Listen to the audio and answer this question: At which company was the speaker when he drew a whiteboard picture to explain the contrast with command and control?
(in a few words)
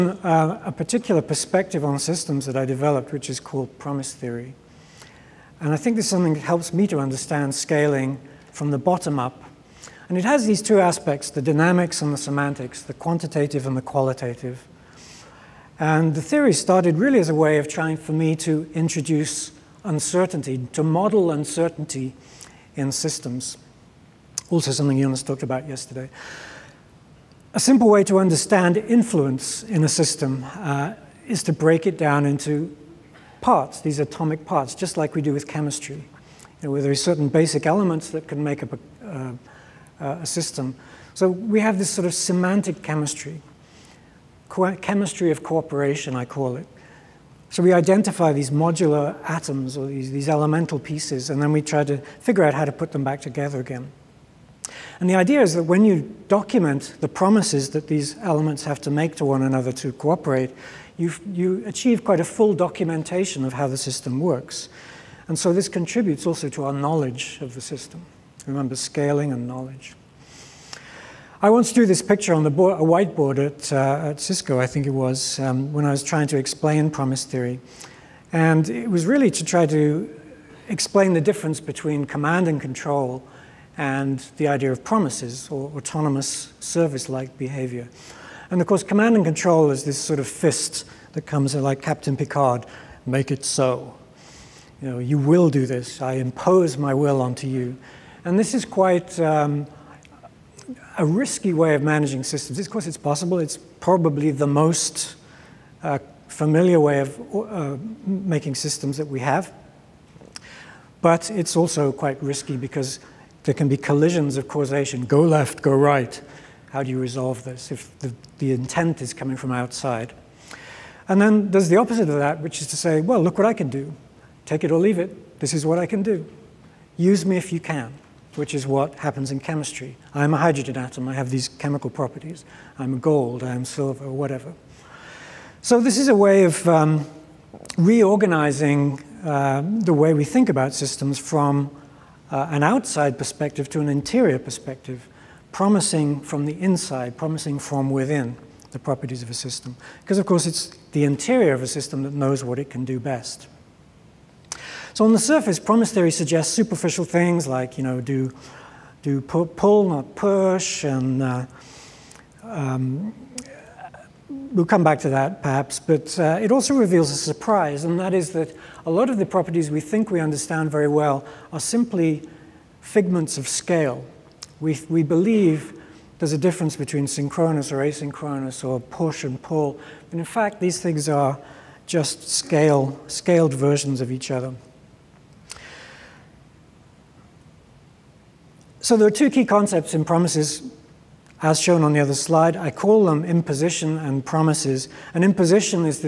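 Cisco.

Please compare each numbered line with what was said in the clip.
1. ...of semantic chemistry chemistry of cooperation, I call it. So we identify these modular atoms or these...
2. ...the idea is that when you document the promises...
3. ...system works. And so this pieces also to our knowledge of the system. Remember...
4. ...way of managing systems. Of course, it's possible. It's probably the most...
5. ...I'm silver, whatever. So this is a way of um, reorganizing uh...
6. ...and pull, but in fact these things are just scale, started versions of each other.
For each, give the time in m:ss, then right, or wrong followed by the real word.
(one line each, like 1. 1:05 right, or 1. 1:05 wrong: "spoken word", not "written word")
1. 0:42 right
2. 0:55 right
3. 1:03 wrong: "contributes", not "pieces"
4. 1:41 right
5. 2:13 right
6. 2:59 wrong: "scaled", not "started".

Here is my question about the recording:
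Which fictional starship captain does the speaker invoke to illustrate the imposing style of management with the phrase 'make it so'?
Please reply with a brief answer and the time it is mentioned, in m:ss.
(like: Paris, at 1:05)
Captain Picard, at 1:31.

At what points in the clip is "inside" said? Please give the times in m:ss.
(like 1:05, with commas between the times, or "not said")
2:26.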